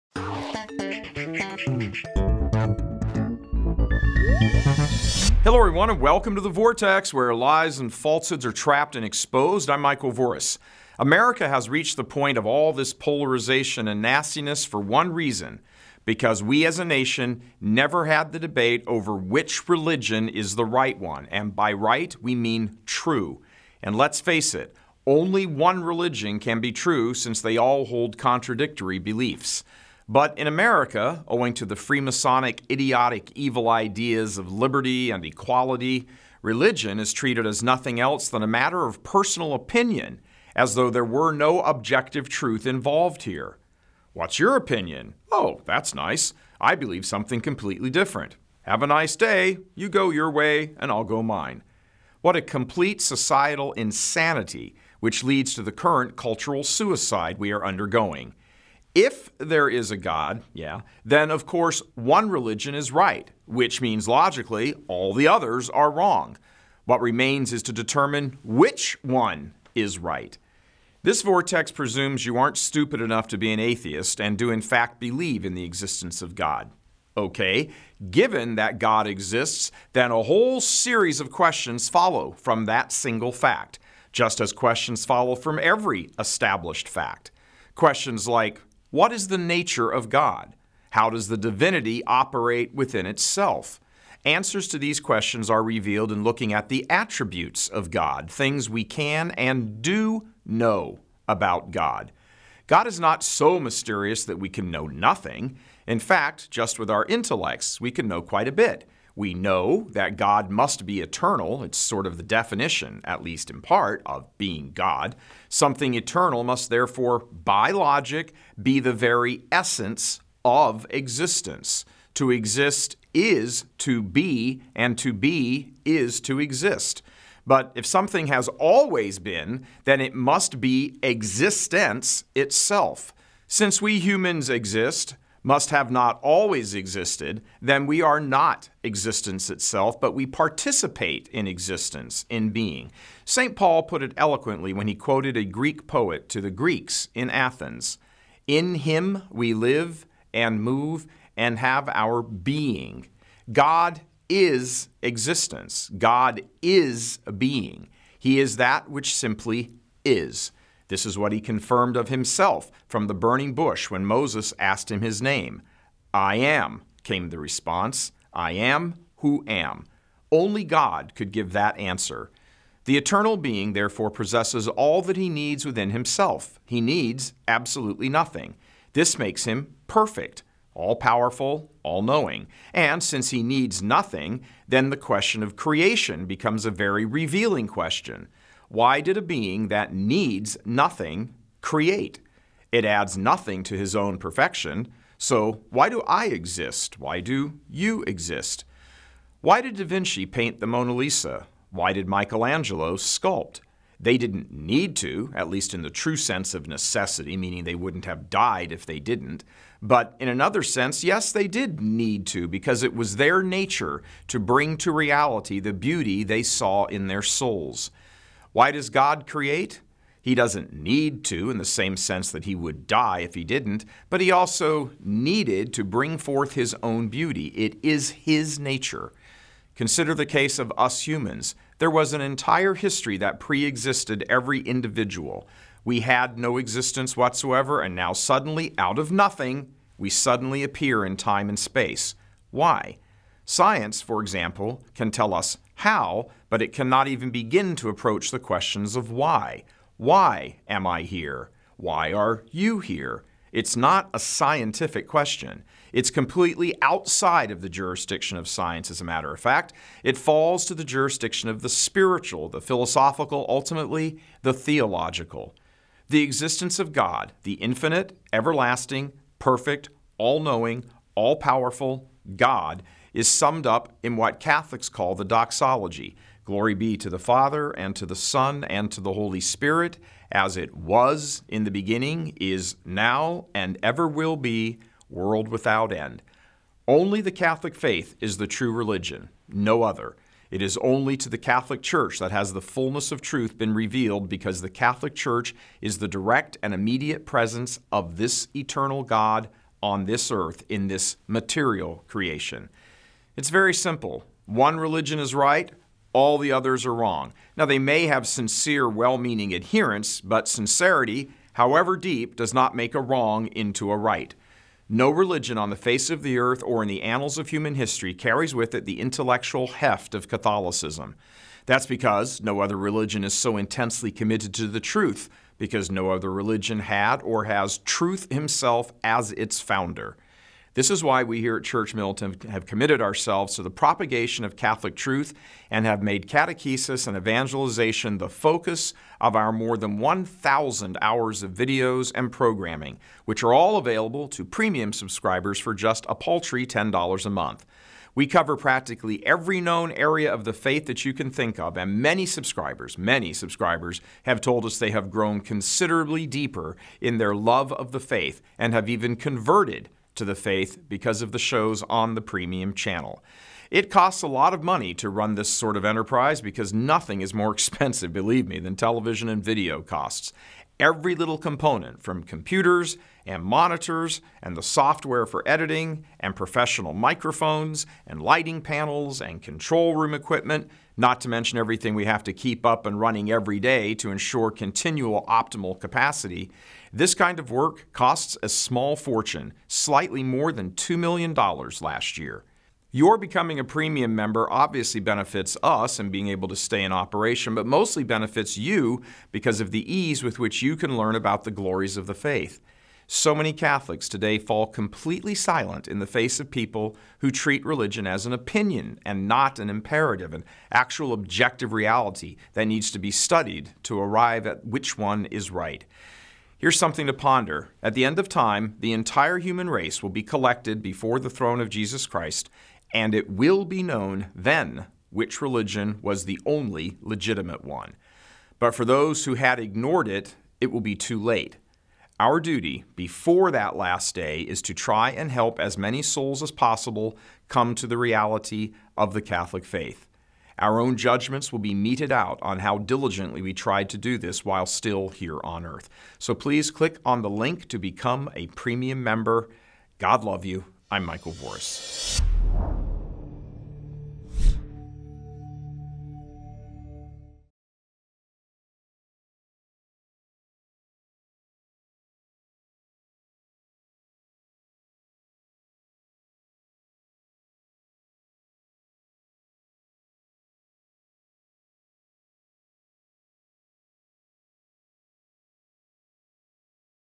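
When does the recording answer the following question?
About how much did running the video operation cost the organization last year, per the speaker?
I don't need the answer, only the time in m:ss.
6:29.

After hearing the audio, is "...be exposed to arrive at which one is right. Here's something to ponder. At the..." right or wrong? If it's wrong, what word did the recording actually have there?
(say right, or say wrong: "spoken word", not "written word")
wrong: "studied", not "exposed".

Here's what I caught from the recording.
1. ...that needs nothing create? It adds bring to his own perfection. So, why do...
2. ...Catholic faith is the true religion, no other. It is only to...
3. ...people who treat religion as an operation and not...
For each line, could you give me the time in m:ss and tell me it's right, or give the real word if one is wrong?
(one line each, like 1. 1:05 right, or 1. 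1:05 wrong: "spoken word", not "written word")
1. 3:09 wrong: "nothing", not "bring"
2. 4:47 right
3. 6:46 wrong: "opinion", not "operation".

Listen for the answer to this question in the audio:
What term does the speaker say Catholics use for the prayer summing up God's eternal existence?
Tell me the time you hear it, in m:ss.
4:35.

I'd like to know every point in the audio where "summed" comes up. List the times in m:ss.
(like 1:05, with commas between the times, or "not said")
4:33.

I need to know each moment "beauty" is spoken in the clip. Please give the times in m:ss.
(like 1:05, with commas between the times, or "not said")
3:35, 3:47.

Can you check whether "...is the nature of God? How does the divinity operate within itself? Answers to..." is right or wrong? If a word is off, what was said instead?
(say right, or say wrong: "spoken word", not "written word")
right.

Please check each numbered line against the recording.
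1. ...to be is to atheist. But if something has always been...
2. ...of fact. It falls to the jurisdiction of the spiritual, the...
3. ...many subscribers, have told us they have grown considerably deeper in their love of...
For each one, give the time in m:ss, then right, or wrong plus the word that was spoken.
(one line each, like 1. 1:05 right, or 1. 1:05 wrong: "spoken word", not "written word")
1. 2:04 wrong: "exist", not "atheist"
2. 4:19 right
3. 5:52 right.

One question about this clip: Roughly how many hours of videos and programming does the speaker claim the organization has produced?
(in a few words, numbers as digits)
more than 1,000 hours.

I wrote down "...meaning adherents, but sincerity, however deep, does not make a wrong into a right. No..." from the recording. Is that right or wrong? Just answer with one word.
right.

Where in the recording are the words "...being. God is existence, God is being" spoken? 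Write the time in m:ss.
2:32.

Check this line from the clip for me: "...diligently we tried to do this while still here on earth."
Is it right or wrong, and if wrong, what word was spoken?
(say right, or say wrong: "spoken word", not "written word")
right.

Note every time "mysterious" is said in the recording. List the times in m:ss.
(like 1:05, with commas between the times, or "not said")
1:43.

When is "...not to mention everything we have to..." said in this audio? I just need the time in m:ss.
6:20.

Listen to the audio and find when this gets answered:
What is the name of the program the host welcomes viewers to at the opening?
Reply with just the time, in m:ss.
0:06.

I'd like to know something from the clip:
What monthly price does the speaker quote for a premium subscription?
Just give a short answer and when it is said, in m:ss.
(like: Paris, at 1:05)
$10, at 5:46.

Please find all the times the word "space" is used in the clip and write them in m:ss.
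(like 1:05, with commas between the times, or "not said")
4:01.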